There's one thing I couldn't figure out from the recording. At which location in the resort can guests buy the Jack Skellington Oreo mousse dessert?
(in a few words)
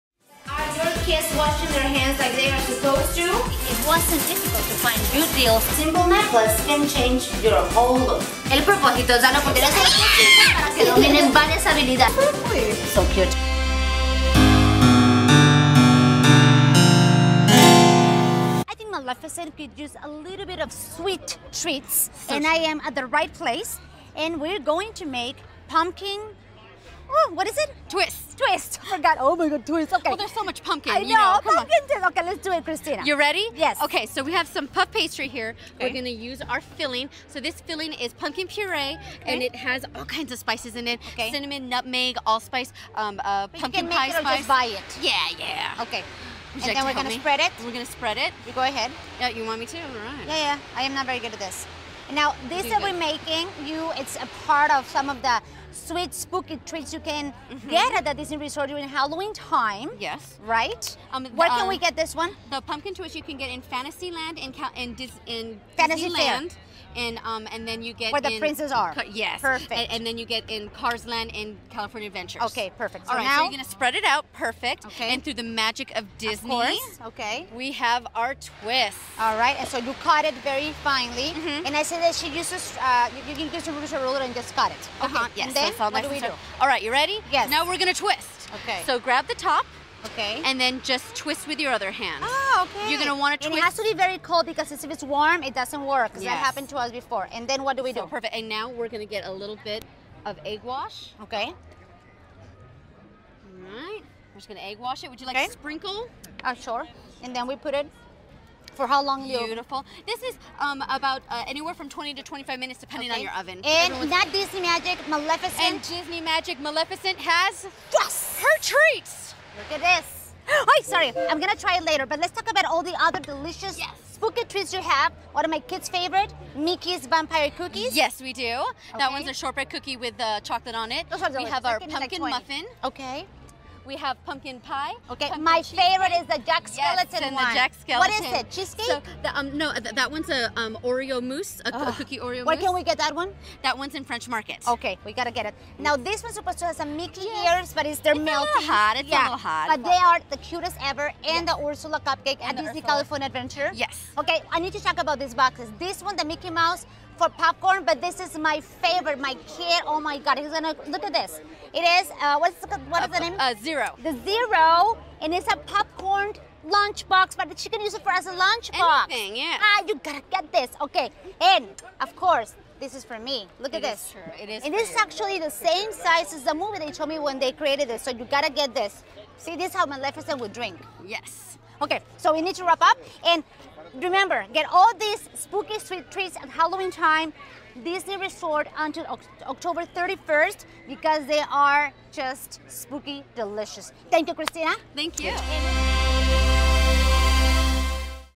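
French Market.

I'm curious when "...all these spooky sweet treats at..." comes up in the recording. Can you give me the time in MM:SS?
03:04.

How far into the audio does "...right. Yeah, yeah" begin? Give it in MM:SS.
00:50.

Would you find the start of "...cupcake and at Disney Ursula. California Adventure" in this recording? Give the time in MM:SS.
02:32.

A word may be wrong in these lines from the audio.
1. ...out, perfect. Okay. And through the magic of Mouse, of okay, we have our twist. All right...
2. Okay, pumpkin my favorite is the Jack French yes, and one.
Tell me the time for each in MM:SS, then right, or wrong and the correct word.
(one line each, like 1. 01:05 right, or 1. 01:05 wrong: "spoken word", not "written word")
1. 01:14 wrong: "Disney", not "Mouse"
2. 02:15 wrong: "Skellington", not "French".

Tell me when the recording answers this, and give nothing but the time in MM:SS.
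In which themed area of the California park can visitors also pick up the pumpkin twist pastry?
01:10.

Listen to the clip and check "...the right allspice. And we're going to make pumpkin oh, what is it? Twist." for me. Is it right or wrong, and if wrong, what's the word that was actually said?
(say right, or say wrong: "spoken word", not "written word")
wrong: "place", not "allspice".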